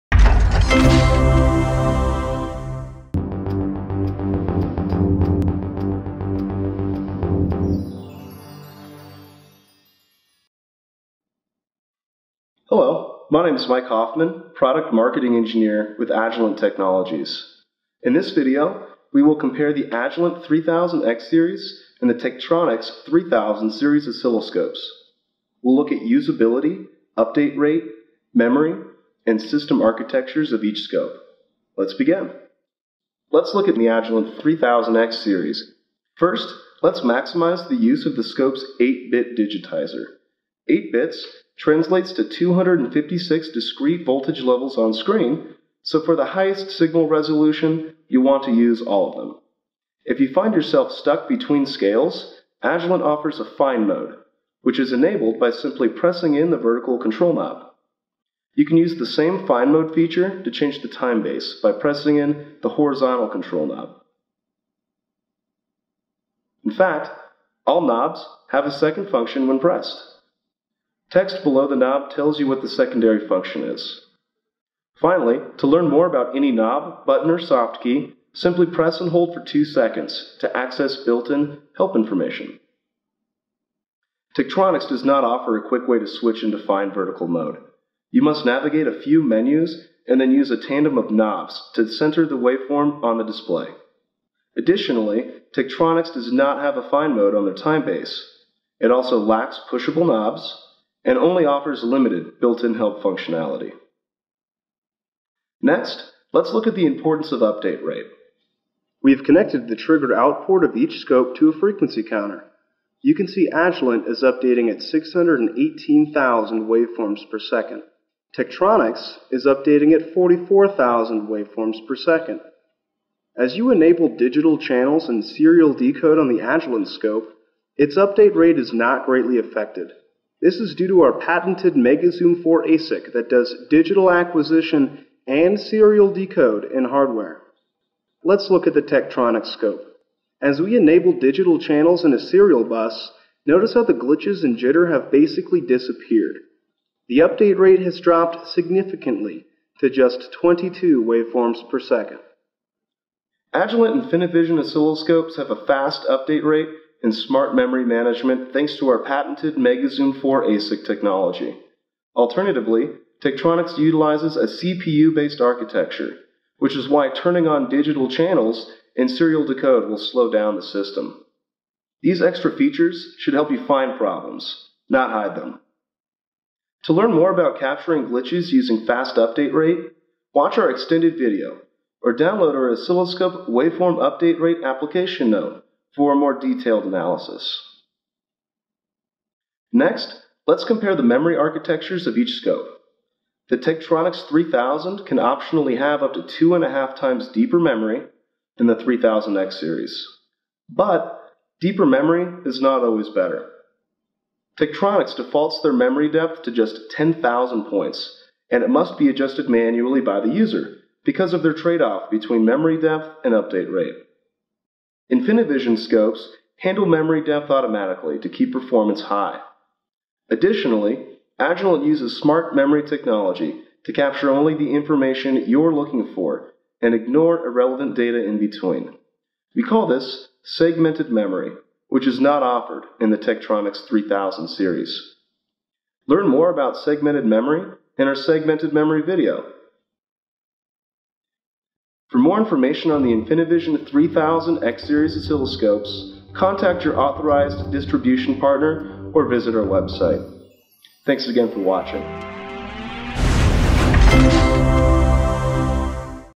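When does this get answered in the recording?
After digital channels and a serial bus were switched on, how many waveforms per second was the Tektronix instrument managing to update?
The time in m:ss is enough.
2:30.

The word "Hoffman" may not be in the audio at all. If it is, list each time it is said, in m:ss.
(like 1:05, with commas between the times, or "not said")
0:13.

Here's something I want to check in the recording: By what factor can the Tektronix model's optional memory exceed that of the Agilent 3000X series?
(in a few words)
2.5 times.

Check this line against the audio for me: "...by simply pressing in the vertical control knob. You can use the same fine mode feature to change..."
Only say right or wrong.
right.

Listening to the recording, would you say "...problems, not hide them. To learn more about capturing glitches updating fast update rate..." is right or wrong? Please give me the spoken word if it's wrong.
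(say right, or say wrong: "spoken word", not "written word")
wrong: "using", not "updating".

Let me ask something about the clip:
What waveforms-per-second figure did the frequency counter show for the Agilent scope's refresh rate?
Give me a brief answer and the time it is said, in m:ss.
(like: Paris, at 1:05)
618,000, at 1:54.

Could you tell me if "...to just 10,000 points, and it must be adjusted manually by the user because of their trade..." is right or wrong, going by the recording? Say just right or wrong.
right.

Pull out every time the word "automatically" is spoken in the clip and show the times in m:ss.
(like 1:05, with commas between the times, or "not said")
3:37.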